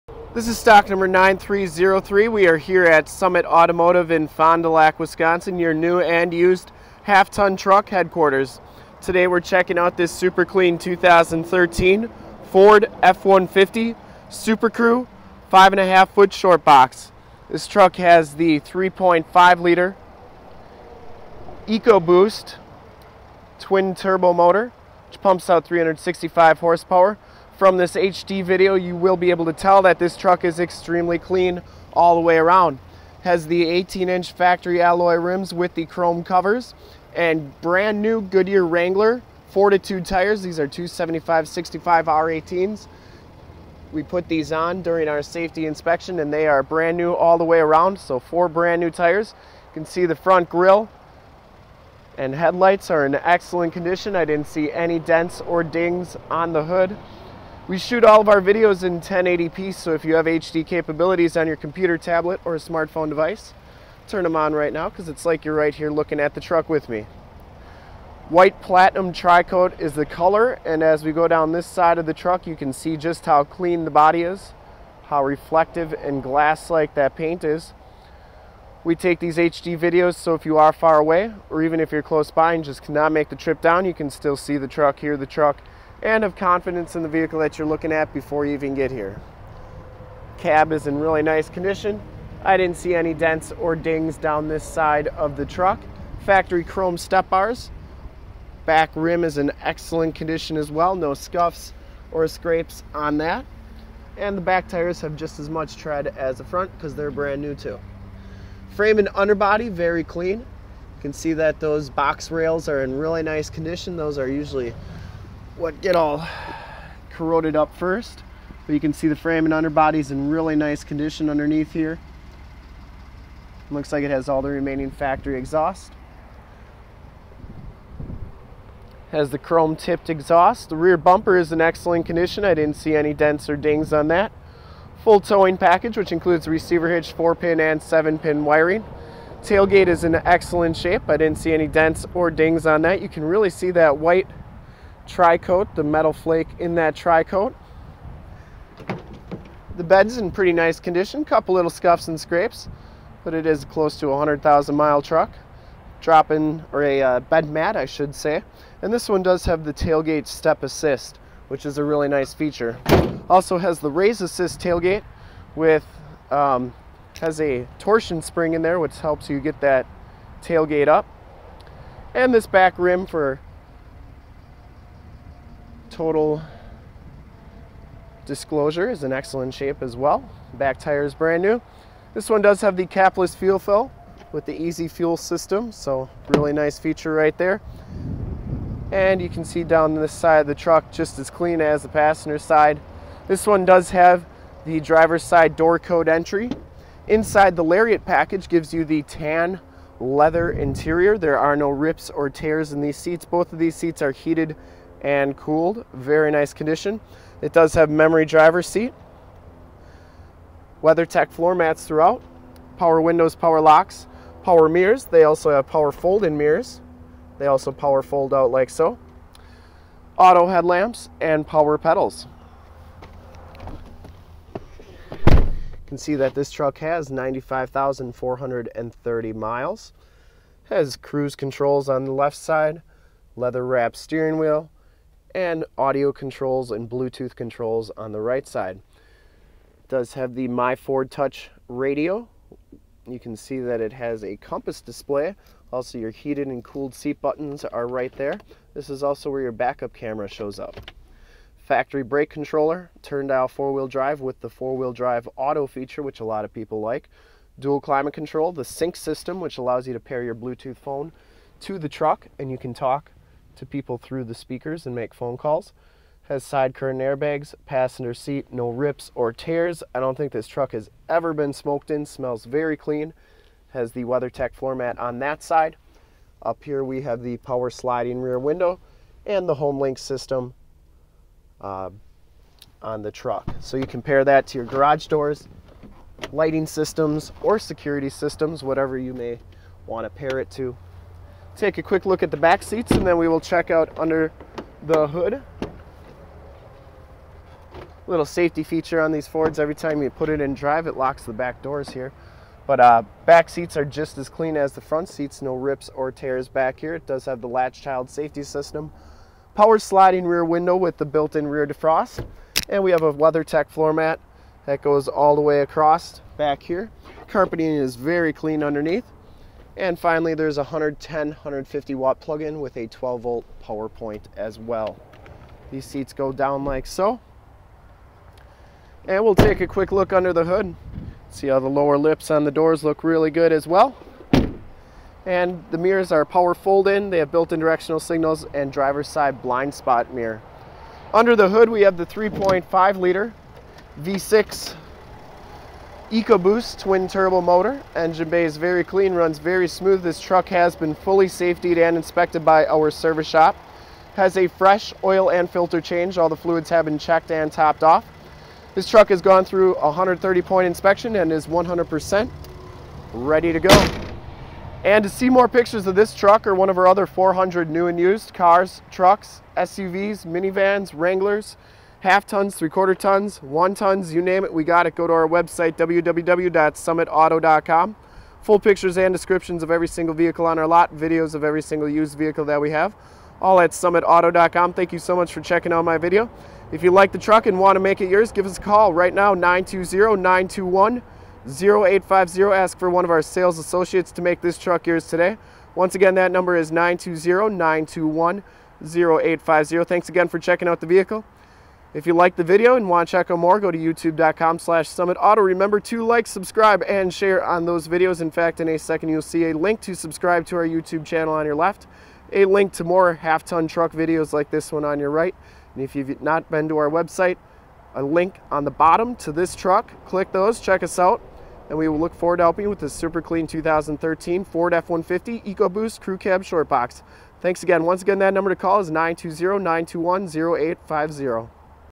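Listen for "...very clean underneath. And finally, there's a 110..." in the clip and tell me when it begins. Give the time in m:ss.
5:17.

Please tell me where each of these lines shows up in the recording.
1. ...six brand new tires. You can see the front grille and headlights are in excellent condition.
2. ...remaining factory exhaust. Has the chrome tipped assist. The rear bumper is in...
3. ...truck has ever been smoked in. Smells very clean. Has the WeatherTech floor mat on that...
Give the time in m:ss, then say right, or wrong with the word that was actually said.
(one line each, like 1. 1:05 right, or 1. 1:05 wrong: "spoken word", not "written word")
1. 0:48 wrong: "four", not "six"
2. 2:04 wrong: "exhaust", not "assist"
3. 4:30 right.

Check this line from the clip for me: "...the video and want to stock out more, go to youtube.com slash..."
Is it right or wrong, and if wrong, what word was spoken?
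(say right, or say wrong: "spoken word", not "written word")
wrong: "check", not "stock".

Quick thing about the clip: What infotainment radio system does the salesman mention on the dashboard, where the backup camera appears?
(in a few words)
My Ford Touch.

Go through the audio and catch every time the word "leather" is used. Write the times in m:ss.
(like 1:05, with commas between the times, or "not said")
3:19, 3:53.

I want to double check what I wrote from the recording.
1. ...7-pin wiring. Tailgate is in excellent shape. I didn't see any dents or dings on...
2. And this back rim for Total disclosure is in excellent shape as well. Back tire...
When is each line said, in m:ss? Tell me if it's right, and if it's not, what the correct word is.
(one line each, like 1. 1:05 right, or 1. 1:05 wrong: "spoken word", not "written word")
1. 2:17 right
2. 2:52 right.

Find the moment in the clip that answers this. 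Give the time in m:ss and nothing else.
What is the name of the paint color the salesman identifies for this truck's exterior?
1:08.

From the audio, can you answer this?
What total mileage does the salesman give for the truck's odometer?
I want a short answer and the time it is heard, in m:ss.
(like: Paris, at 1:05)
95,430, at 3:47.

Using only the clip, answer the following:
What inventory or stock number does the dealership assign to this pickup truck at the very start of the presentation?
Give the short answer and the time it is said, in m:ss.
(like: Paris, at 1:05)
9303, at 0:00.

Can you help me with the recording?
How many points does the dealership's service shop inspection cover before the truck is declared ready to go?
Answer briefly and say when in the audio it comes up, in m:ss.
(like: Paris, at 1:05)
130, at 5:59.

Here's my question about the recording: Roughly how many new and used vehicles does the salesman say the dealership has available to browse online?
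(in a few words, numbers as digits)
400.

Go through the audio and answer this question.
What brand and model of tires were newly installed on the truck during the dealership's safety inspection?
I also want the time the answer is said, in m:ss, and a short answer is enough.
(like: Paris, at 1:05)
Goodyear Wrangler Fortitude, at 0:38.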